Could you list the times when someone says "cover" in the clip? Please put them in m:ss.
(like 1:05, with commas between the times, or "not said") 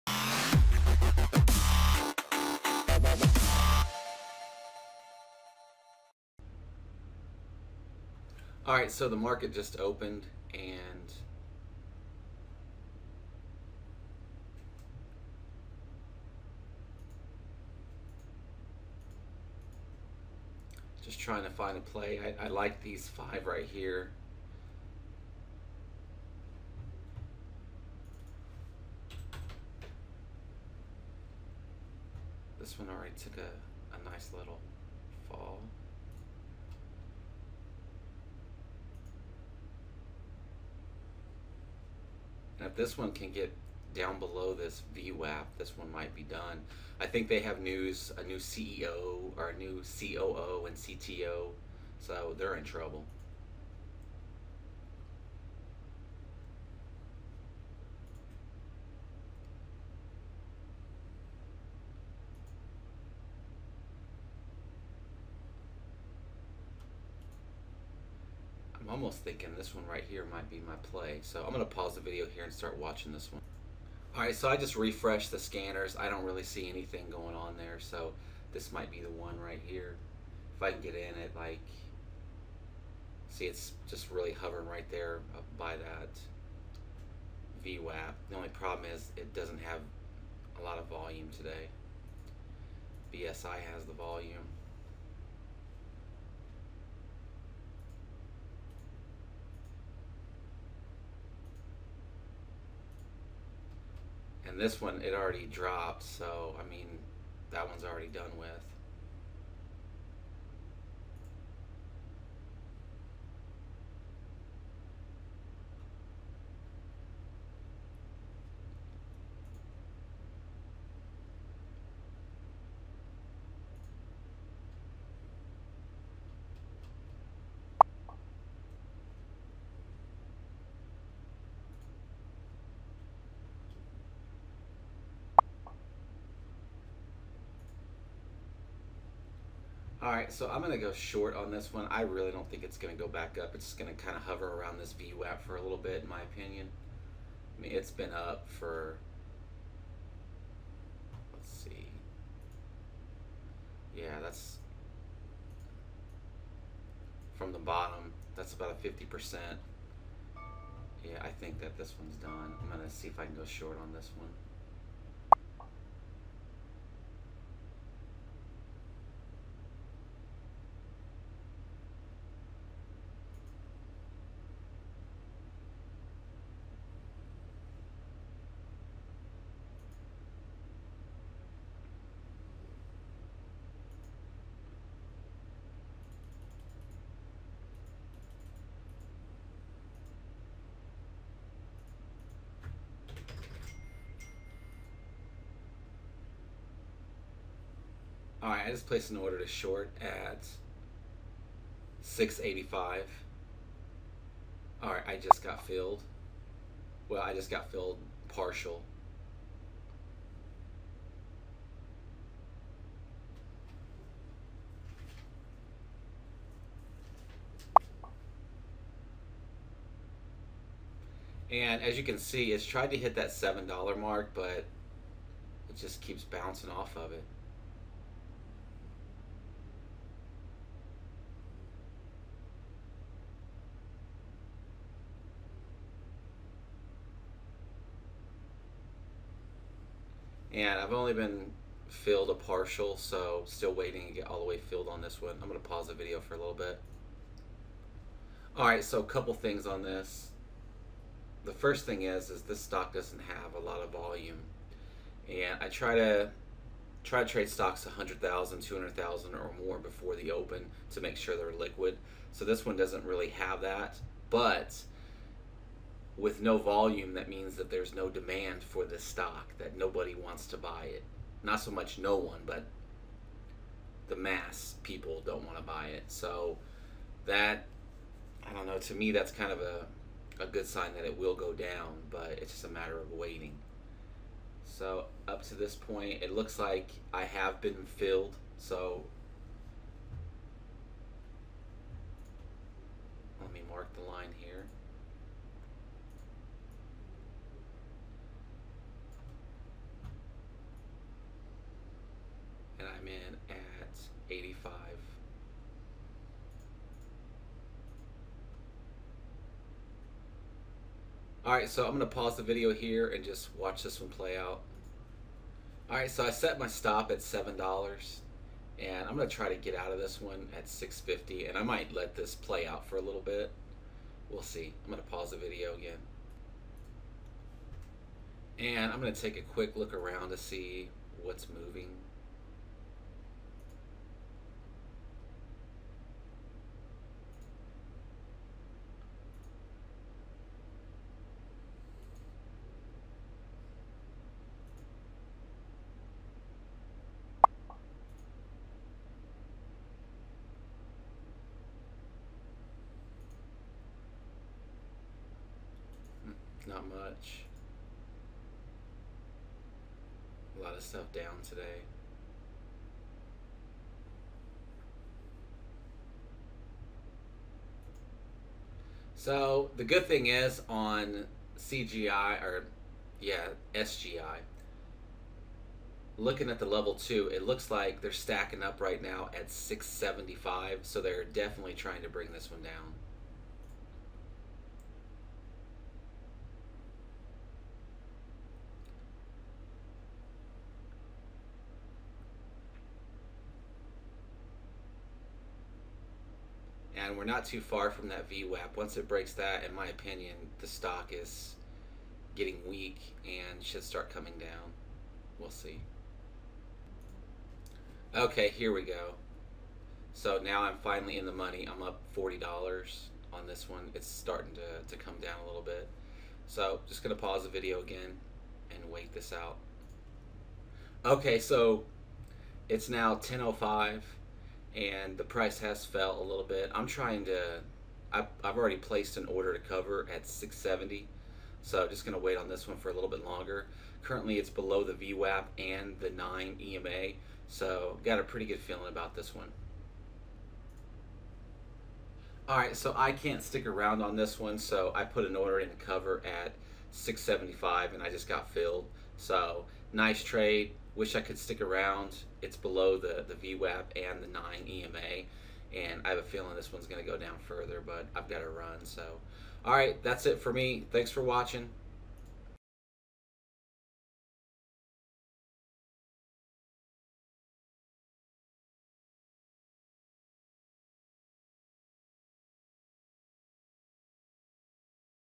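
7:09, 7:25.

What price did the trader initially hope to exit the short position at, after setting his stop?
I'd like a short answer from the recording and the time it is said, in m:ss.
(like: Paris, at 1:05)
6.50, at 5:20.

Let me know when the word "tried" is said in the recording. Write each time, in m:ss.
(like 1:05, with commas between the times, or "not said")
3:42.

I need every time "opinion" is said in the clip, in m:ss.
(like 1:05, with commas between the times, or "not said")
2:26, 6:39.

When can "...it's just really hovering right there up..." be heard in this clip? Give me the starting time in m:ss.
1:23.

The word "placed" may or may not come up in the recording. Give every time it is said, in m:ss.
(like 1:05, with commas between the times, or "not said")
3:18, 7:08.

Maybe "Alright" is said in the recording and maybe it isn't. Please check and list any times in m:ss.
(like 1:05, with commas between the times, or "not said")
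5:11, 5:15.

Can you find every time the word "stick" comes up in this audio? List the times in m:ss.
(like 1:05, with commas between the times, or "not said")
7:23, 7:31.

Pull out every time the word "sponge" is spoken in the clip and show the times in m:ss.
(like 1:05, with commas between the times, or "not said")
not said.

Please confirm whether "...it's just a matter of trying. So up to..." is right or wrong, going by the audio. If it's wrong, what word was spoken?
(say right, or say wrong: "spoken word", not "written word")
wrong: "waiting", not "trying".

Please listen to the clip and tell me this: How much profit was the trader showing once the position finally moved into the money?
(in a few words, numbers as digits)
$40.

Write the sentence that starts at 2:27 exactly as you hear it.
I mean, it's been up for, let's see.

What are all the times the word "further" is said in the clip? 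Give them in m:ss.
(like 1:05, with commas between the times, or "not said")
7:37.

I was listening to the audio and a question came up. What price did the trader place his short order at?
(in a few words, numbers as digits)
6.85.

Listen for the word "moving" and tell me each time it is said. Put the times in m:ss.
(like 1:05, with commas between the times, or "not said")
5:31.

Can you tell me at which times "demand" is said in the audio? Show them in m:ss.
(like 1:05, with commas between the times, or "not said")
4:28.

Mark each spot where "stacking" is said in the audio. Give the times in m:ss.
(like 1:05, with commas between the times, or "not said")
6:18.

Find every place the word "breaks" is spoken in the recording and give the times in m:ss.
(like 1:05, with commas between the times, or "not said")
6:39.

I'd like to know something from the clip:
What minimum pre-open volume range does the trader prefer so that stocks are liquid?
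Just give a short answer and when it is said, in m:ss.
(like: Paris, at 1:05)
100,000 to 200,000, at 4:17.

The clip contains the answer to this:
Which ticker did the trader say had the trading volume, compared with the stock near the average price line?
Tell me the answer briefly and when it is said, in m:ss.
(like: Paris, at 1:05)
BSI, at 1:33.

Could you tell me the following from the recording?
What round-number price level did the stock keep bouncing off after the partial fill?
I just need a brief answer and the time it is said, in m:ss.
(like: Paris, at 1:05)
$7, at 3:43.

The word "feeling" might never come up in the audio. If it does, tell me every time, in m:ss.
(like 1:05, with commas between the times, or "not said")
7:18, 7:36.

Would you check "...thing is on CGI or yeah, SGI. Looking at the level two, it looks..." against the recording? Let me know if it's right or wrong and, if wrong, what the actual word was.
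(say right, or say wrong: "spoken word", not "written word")
right.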